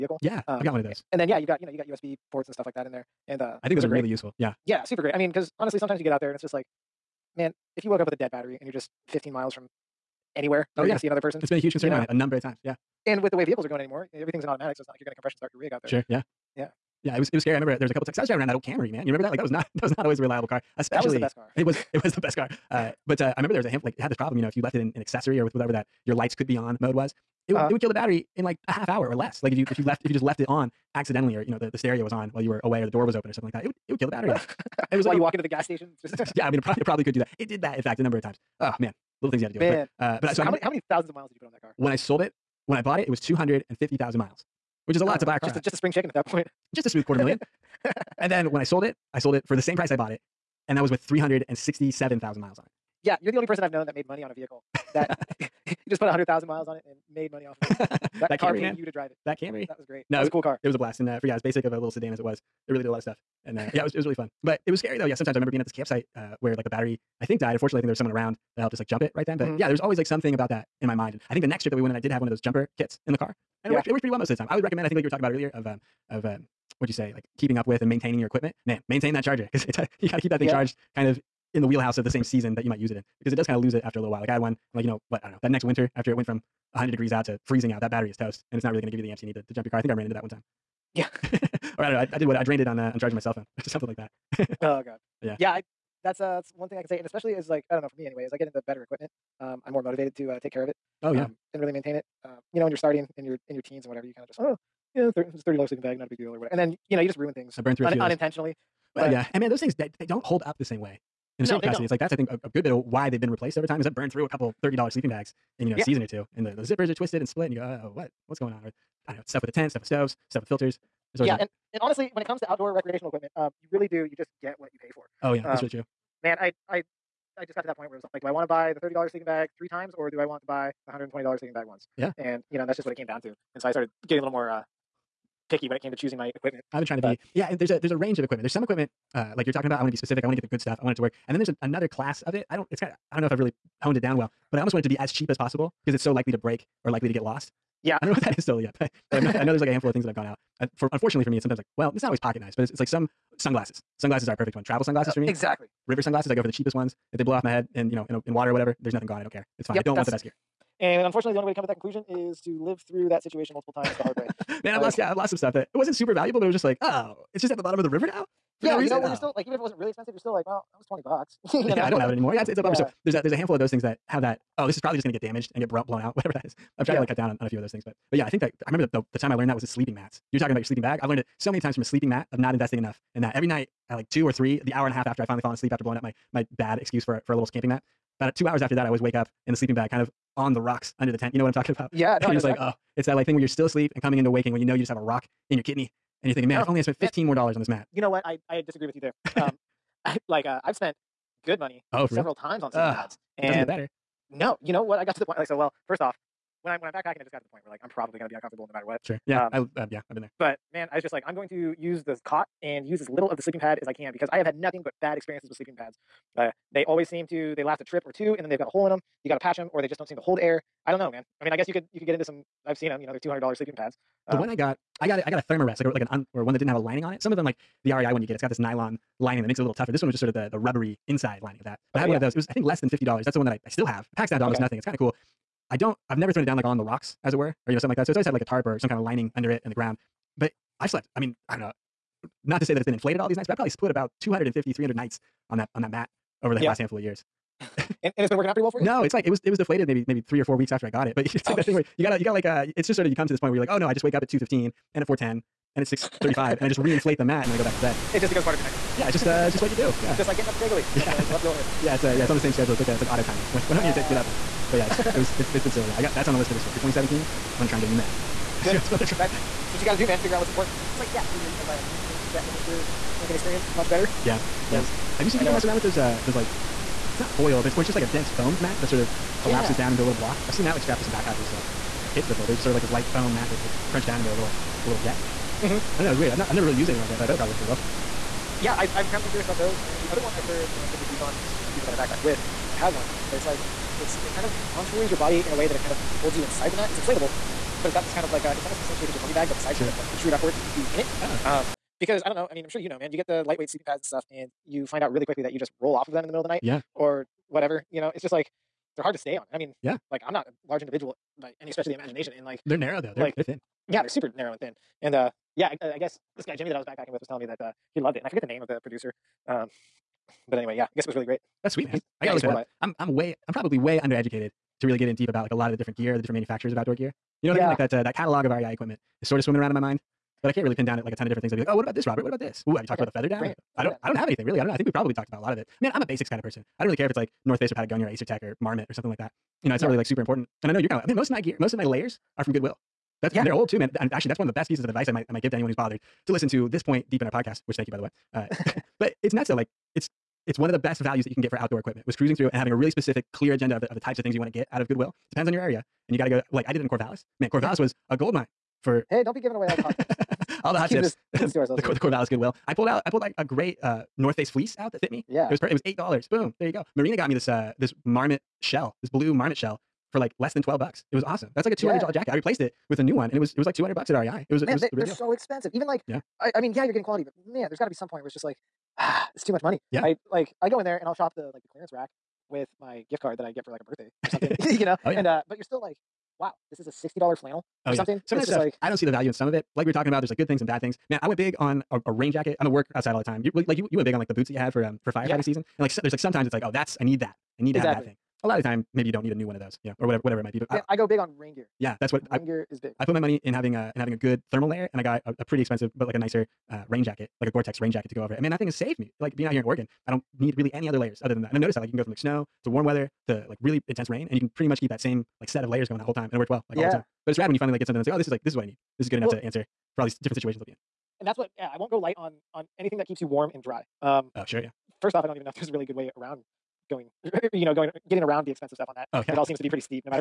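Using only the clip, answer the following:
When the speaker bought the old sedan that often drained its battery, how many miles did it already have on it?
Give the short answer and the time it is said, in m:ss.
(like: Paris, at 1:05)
250,000, at 0:43.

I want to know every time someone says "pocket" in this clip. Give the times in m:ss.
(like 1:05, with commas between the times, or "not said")
2:32.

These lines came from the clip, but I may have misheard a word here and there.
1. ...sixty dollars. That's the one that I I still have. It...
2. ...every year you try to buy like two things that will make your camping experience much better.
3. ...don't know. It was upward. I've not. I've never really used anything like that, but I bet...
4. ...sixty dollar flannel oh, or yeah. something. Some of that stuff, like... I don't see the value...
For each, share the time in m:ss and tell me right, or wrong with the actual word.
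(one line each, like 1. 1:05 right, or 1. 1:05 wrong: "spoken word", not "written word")
1. 3:52 wrong: "fifty", not "sixty"
2. 4:31 right
3. 4:46 wrong: "weird", not "upward"
4. 6:26 right.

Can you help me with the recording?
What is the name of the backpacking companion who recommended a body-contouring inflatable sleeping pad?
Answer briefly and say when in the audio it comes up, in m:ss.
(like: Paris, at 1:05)
Jimmy, at 5:16.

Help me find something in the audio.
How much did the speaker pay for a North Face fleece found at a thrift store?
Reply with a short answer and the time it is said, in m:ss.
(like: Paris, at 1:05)
$8, at 6:05.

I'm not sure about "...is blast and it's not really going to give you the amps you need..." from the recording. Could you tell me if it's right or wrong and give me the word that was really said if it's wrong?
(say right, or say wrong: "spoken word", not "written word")
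wrong: "toast", not "blast".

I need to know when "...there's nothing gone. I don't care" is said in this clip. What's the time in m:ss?
2:38.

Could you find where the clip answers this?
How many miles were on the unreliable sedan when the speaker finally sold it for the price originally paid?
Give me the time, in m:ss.
0:50.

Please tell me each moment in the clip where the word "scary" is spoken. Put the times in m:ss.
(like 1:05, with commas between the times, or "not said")
0:17, 1:04.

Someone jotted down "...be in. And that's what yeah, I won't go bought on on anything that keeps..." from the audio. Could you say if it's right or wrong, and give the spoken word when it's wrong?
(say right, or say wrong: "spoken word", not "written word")
wrong: "light", not "bought".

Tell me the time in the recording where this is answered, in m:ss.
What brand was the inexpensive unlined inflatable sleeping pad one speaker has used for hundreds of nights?
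3:45.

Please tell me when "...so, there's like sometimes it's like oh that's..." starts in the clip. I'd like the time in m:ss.
6:35.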